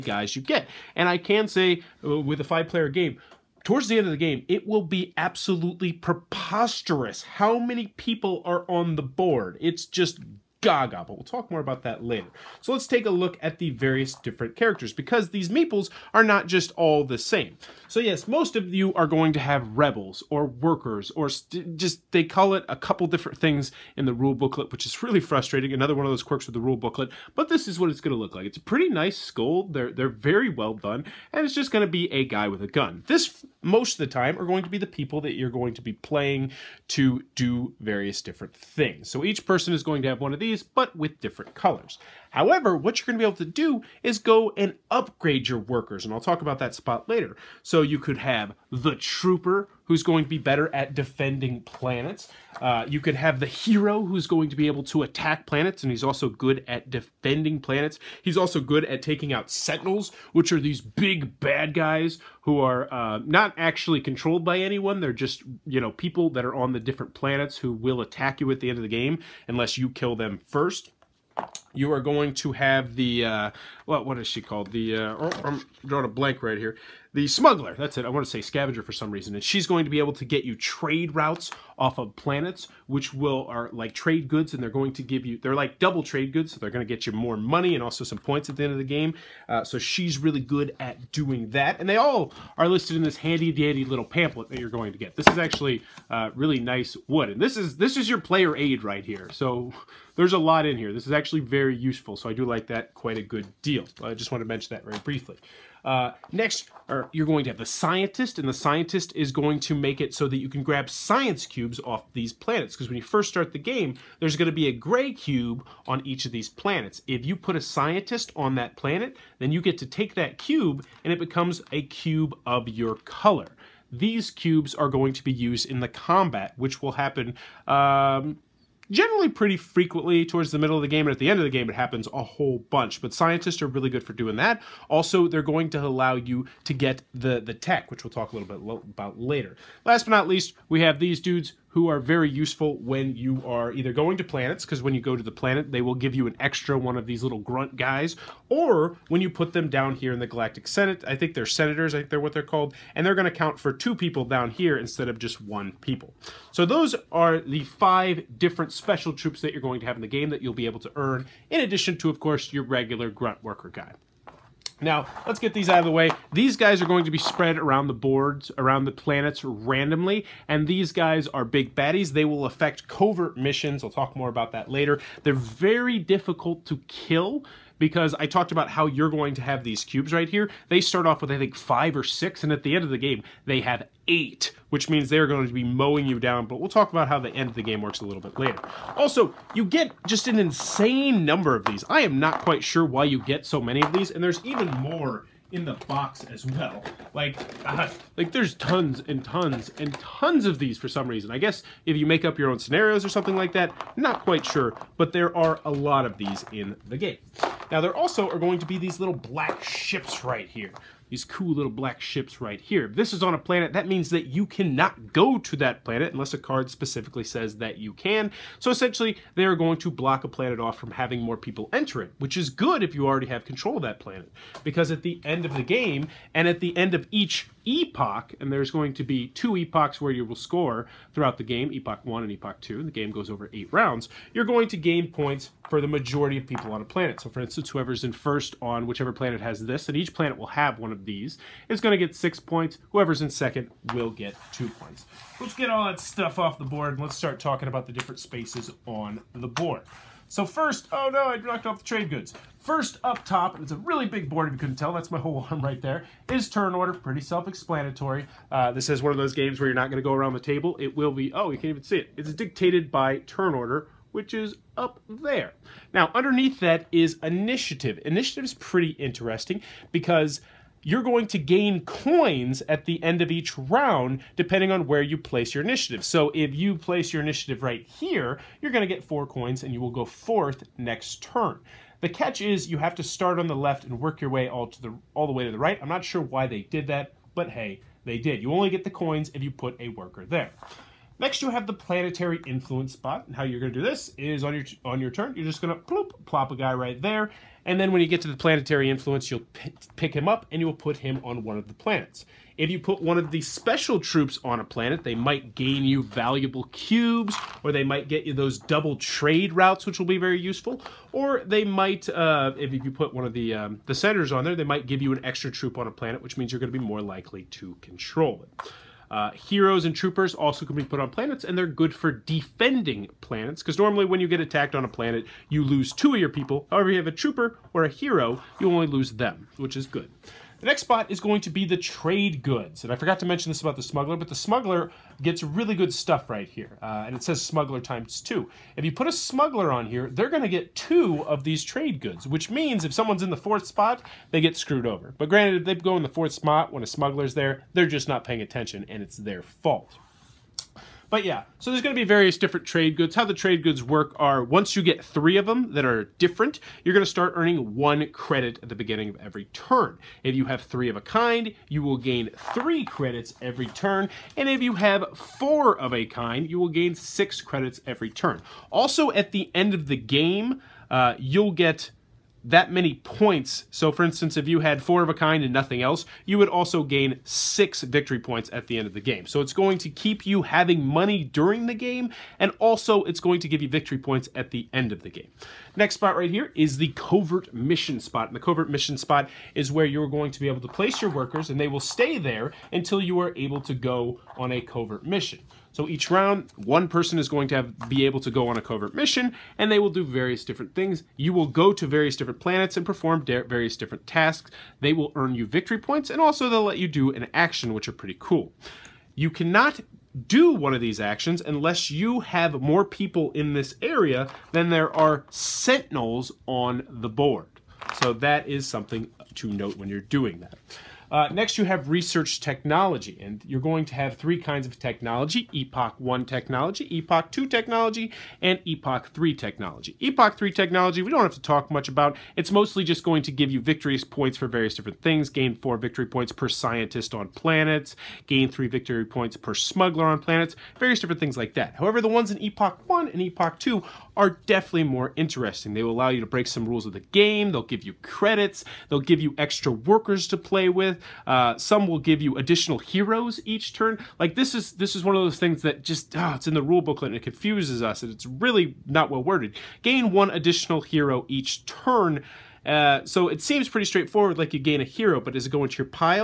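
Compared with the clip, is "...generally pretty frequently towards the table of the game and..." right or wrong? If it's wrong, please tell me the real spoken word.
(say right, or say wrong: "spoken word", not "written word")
wrong: "middle", not "table".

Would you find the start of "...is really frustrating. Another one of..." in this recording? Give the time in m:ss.
0:24.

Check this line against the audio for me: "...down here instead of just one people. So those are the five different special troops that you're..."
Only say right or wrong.
right.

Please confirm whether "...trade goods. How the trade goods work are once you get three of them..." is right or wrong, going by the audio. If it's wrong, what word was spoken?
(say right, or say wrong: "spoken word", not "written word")
right.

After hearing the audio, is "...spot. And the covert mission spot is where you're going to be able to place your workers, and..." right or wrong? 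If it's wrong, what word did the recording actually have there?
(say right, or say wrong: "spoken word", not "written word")
right.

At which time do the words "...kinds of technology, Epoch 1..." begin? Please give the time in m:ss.
7:04.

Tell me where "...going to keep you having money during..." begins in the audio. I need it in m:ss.
6:19.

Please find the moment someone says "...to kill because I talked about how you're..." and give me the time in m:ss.
2:56.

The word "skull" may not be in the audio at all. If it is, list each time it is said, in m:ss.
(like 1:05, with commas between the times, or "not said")
0:29.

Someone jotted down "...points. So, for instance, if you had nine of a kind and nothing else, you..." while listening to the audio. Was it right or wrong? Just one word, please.
wrong.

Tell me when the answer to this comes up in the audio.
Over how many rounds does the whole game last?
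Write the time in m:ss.
3:53.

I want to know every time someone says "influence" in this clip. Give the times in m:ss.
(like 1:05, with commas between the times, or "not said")
4:52, 4:58.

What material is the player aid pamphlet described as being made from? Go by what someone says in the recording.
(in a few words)
Wood.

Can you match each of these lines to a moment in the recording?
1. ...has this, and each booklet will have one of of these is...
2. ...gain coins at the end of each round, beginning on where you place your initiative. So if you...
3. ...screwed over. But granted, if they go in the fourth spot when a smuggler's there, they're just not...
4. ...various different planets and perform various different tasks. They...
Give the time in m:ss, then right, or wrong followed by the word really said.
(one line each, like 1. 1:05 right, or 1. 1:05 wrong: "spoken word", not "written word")
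1. 3:59 wrong: "planet", not "booklet"
2. 4:31 wrong: "depending", not "beginning"
3. 5:44 right
4. 6:41 right.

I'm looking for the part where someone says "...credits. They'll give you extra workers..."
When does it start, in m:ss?
7:28.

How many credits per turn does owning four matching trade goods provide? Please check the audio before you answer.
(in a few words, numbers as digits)
6.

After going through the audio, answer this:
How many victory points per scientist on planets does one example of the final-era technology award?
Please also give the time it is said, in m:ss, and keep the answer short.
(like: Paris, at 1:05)
4, at 7:15.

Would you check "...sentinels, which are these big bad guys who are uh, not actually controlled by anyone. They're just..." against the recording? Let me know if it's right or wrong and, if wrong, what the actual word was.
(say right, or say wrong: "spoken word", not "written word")
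right.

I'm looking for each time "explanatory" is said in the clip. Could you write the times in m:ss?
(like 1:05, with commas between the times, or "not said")
4:17.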